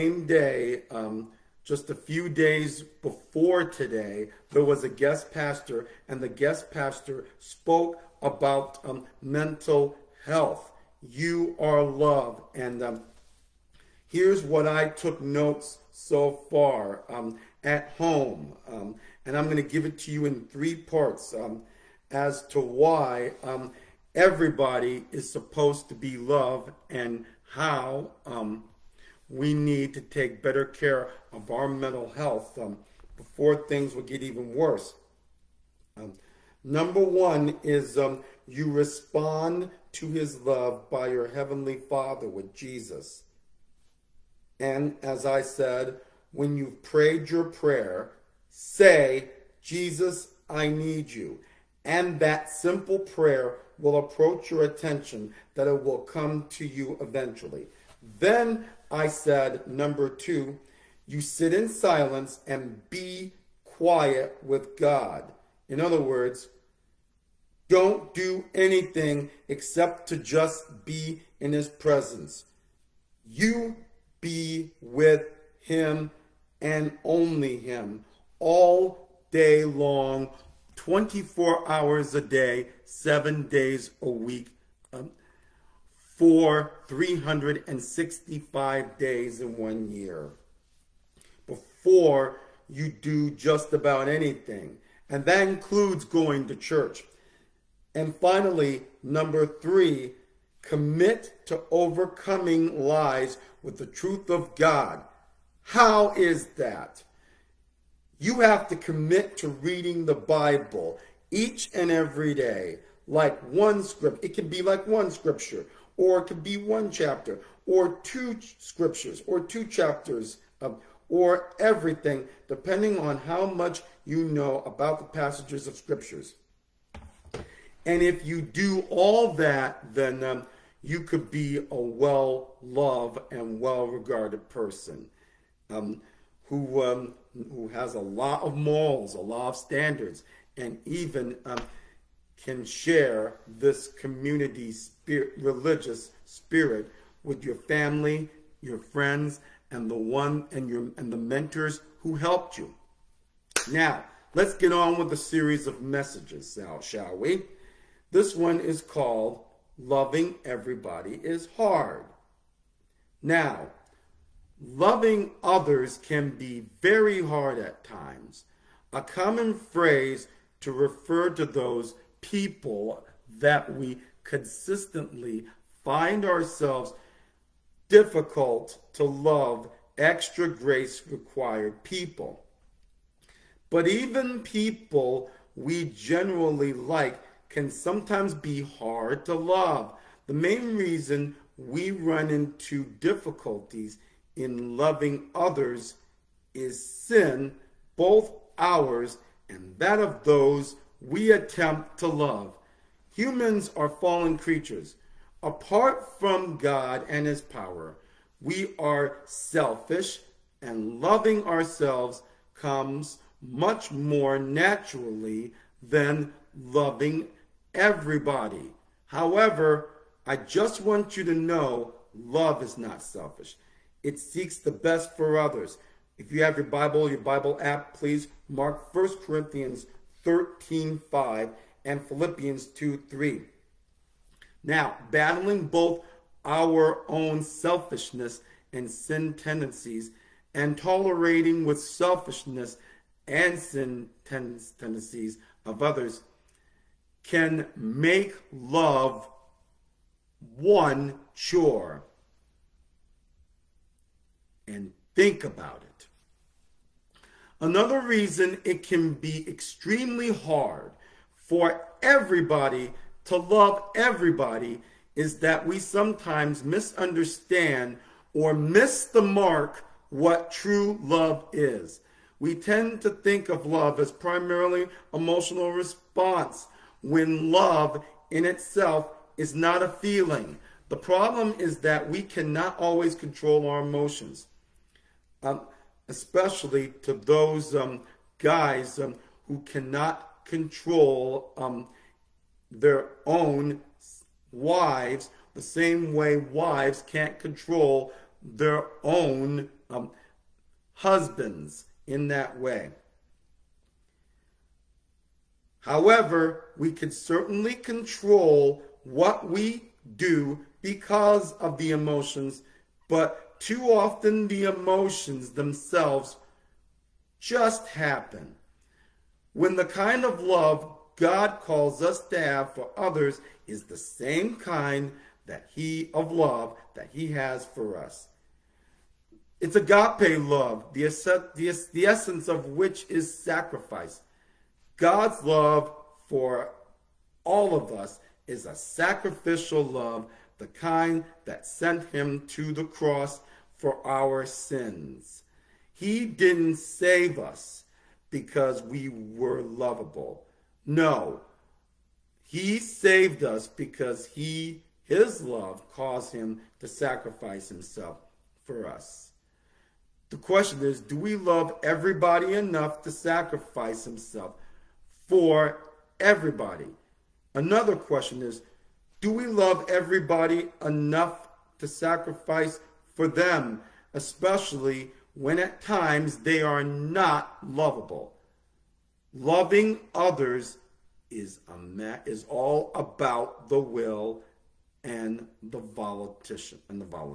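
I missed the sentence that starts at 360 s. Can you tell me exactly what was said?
The question is, do we love everybody enough to sacrifice himself for everybody?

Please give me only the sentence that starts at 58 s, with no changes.
Then I said, number two, you sit in silence and be quiet with God.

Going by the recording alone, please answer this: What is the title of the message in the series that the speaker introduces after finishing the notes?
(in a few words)
Loving Everybody is Hard.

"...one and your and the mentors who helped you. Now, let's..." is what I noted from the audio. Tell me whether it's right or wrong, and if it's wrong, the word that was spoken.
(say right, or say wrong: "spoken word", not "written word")
right.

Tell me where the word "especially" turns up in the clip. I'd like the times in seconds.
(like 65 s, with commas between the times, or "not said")
286 s, 374 s.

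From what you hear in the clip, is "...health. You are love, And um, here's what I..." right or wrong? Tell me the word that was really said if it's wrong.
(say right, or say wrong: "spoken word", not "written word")
right.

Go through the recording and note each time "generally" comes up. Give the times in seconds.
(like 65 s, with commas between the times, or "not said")
185 s.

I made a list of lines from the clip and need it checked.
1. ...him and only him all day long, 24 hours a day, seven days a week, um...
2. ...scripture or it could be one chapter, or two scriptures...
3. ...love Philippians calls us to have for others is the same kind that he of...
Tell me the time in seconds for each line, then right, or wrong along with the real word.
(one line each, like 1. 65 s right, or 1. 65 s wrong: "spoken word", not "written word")
1. 75 s right
2. 115 s right
3. 320 s wrong: "God", not "Philippians".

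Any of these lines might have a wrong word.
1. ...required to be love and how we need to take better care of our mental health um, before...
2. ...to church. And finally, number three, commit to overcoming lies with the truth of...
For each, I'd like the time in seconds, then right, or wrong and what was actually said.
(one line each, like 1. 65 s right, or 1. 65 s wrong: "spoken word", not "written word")
1. 25 s wrong: "supposed", not "required"
2. 96 s right.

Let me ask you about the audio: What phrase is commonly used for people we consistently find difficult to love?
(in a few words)
extra grace required people.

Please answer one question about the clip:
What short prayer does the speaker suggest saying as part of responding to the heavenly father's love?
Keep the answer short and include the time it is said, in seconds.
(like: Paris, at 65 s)
Jesus, I need you, at 49 s.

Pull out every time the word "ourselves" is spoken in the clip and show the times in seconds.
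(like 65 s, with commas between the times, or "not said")
176 s, 211 s.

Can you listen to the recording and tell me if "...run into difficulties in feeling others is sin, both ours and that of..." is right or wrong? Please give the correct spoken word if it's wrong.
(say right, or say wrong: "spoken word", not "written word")
wrong: "loving", not "feeling".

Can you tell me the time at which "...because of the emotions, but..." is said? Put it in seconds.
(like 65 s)
310 s.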